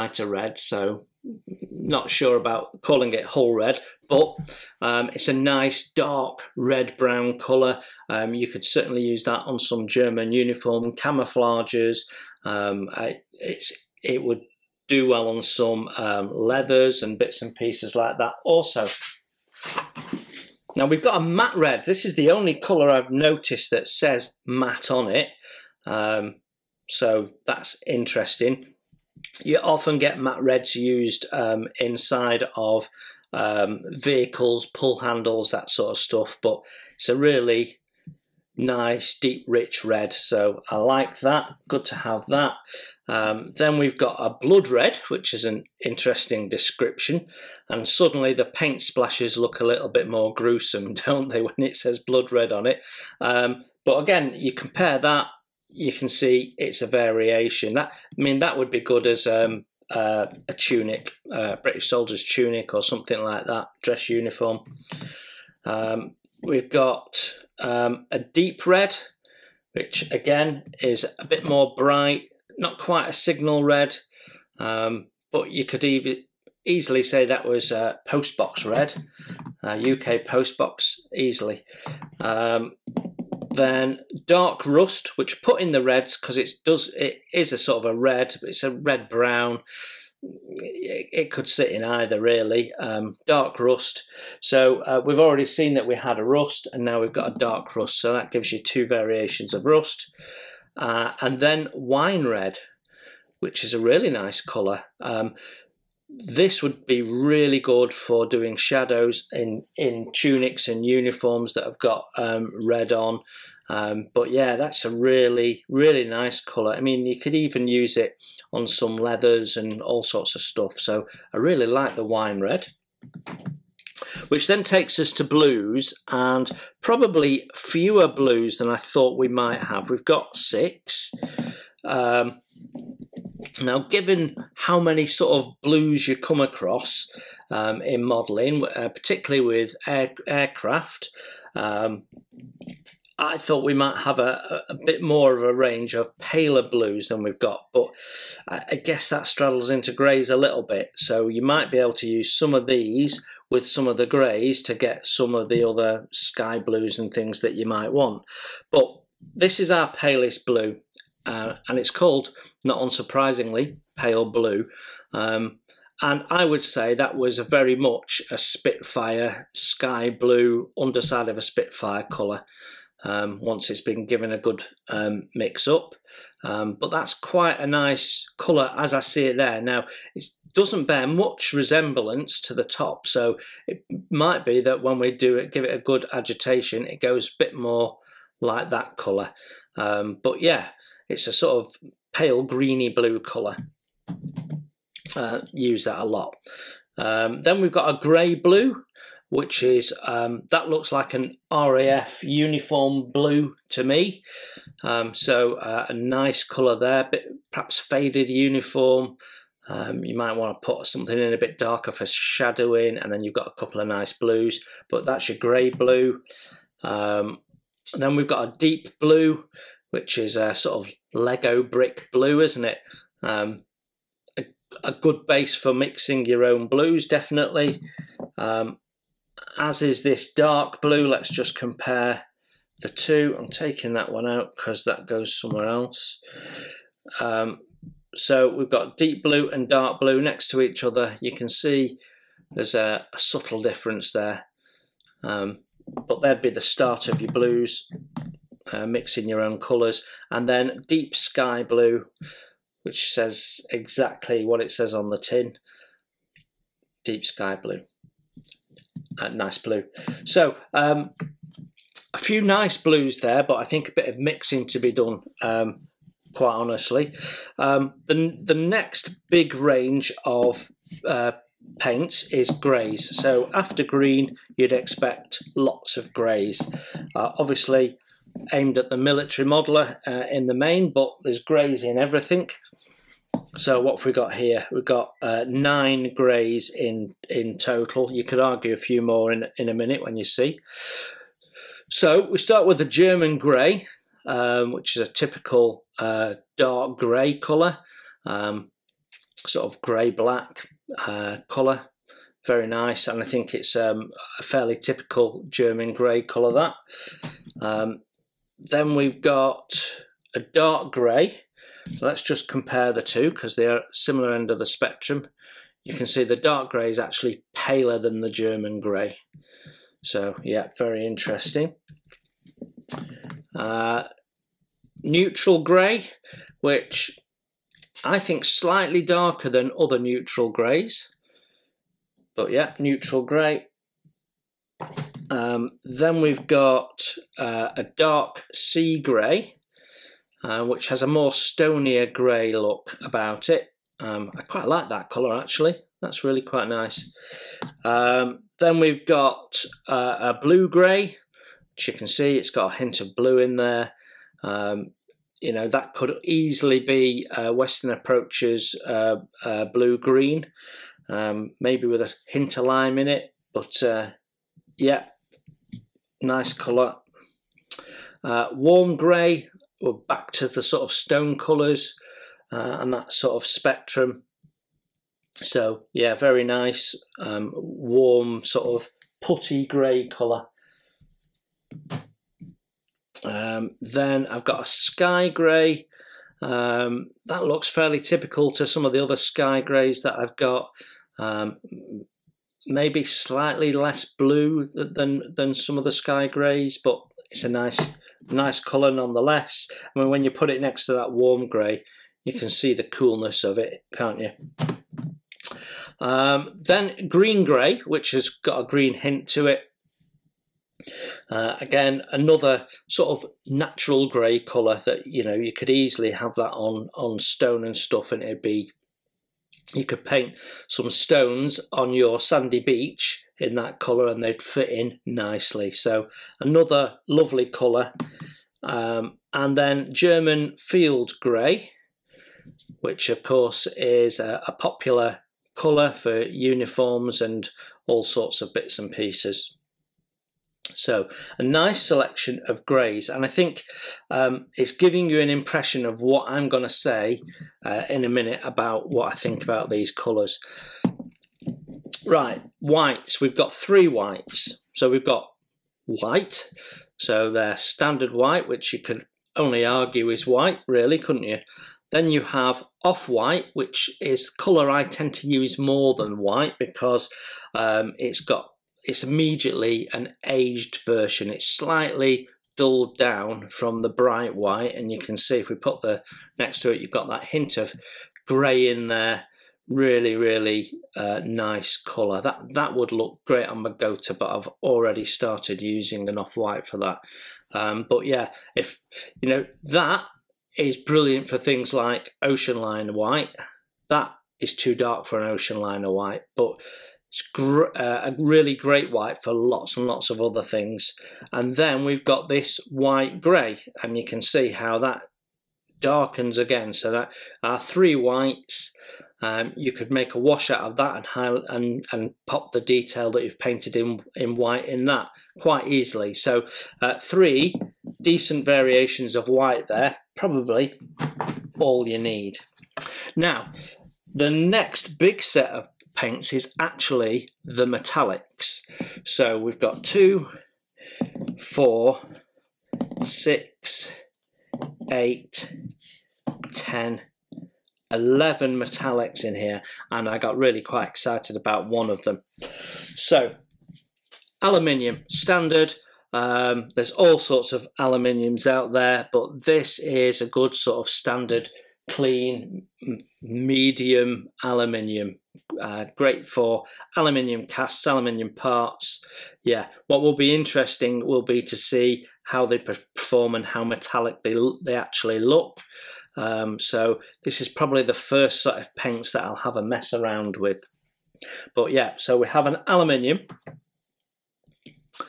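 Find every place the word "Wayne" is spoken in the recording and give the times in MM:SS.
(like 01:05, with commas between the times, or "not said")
not said.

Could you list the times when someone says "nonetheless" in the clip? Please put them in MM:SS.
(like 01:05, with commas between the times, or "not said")
06:38.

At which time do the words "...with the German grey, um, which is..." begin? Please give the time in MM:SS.
04:52.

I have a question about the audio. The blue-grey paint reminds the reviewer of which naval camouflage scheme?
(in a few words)
Western Approaches.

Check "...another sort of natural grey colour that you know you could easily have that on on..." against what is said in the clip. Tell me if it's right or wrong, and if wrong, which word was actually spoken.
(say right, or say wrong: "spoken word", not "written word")
right.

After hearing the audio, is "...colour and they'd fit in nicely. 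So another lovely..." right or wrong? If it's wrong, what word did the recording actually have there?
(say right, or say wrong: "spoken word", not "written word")
right.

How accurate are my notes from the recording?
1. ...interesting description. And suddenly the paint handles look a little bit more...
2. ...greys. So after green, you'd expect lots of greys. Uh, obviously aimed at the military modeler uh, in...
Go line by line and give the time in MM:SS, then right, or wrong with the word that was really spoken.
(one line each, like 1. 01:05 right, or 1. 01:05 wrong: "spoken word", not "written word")
1. 00:45 wrong: "splashes", not "handles"
2. 04:32 right.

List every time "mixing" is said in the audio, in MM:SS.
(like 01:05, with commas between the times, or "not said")
03:45, 04:08, 04:24.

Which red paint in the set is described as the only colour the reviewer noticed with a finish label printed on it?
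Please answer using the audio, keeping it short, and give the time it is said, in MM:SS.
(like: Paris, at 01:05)
Matte red, at 00:21.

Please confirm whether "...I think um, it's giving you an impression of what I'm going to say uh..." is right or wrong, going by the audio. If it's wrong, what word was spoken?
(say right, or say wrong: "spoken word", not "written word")
right.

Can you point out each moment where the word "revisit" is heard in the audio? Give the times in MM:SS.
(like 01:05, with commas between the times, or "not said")
not said.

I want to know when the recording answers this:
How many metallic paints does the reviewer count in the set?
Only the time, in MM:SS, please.
08:57.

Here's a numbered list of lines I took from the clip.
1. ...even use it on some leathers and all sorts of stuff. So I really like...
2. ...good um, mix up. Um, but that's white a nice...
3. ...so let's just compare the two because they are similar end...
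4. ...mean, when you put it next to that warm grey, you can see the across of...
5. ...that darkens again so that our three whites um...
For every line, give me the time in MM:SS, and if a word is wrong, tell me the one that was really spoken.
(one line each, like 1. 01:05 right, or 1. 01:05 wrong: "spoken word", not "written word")
1. 01:57 right
2. 02:54 wrong: "quite", not "white"
3. 05:11 right
4. 06:39 wrong: "coolness", not "across"
5. 08:24 right.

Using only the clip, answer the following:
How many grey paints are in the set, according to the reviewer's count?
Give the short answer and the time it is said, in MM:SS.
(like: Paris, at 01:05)
9, at 04:45.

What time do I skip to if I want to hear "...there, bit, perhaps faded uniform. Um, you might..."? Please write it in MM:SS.
03:26.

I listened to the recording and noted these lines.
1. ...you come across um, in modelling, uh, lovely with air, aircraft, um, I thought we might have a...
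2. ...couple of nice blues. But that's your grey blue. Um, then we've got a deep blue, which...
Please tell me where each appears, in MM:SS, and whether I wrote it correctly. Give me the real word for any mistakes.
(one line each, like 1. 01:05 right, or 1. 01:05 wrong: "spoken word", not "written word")
1. 02:16 wrong: "particularly", not "lovely"
2. 03:33 right.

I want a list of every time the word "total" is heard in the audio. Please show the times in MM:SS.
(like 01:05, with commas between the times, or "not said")
04:47.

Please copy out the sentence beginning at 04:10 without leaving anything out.
And then deep sky blue, which says exactly what it says on the tin, deep sky blue nice blue.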